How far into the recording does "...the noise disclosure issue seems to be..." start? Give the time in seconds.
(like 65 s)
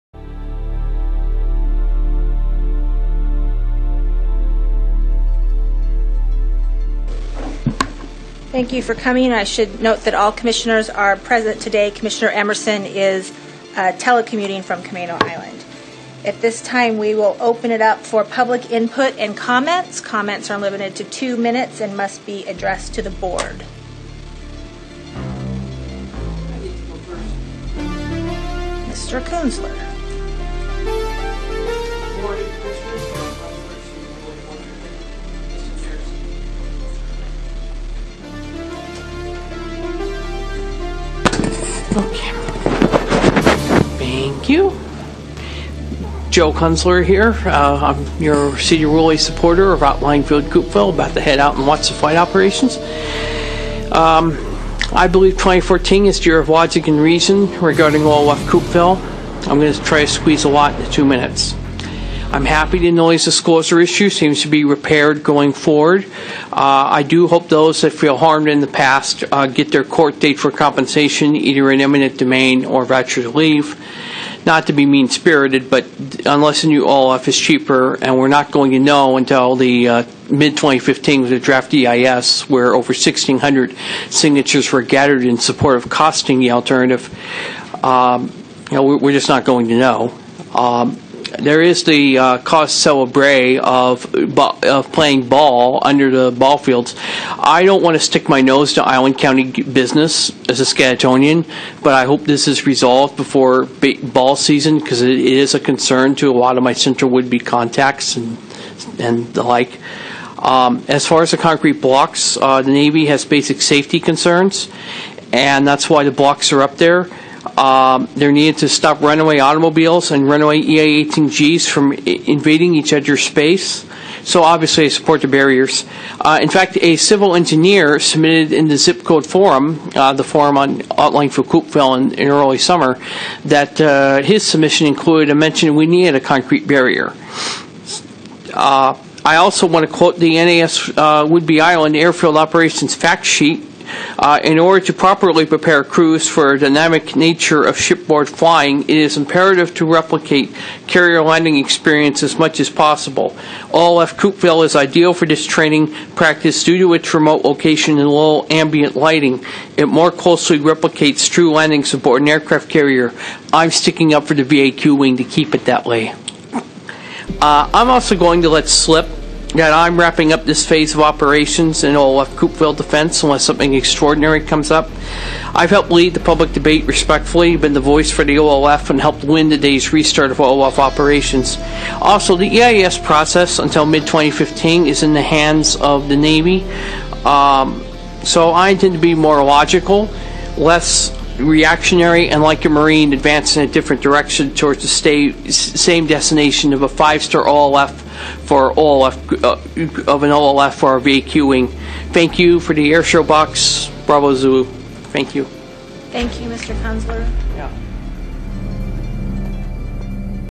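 62 s.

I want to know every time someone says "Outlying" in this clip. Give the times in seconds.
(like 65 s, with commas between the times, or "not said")
49 s, 130 s.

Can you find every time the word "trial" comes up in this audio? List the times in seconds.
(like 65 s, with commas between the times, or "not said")
not said.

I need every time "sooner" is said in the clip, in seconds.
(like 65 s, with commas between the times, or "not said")
not said.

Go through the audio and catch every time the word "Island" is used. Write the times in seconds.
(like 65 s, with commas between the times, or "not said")
15 s, 98 s, 141 s.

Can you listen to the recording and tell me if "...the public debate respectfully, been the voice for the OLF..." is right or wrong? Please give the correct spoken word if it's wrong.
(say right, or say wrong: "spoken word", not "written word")
right.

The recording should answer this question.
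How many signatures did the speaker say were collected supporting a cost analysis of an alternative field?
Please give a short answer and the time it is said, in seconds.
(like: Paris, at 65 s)
1,600, at 82 s.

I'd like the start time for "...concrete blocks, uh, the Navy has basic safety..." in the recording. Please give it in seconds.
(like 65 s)
111 s.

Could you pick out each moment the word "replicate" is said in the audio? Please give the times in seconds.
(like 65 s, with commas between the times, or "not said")
149 s, 160 s.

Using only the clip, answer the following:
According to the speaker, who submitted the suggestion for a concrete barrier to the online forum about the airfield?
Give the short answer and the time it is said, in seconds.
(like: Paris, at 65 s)
a civil engineer, at 126 s.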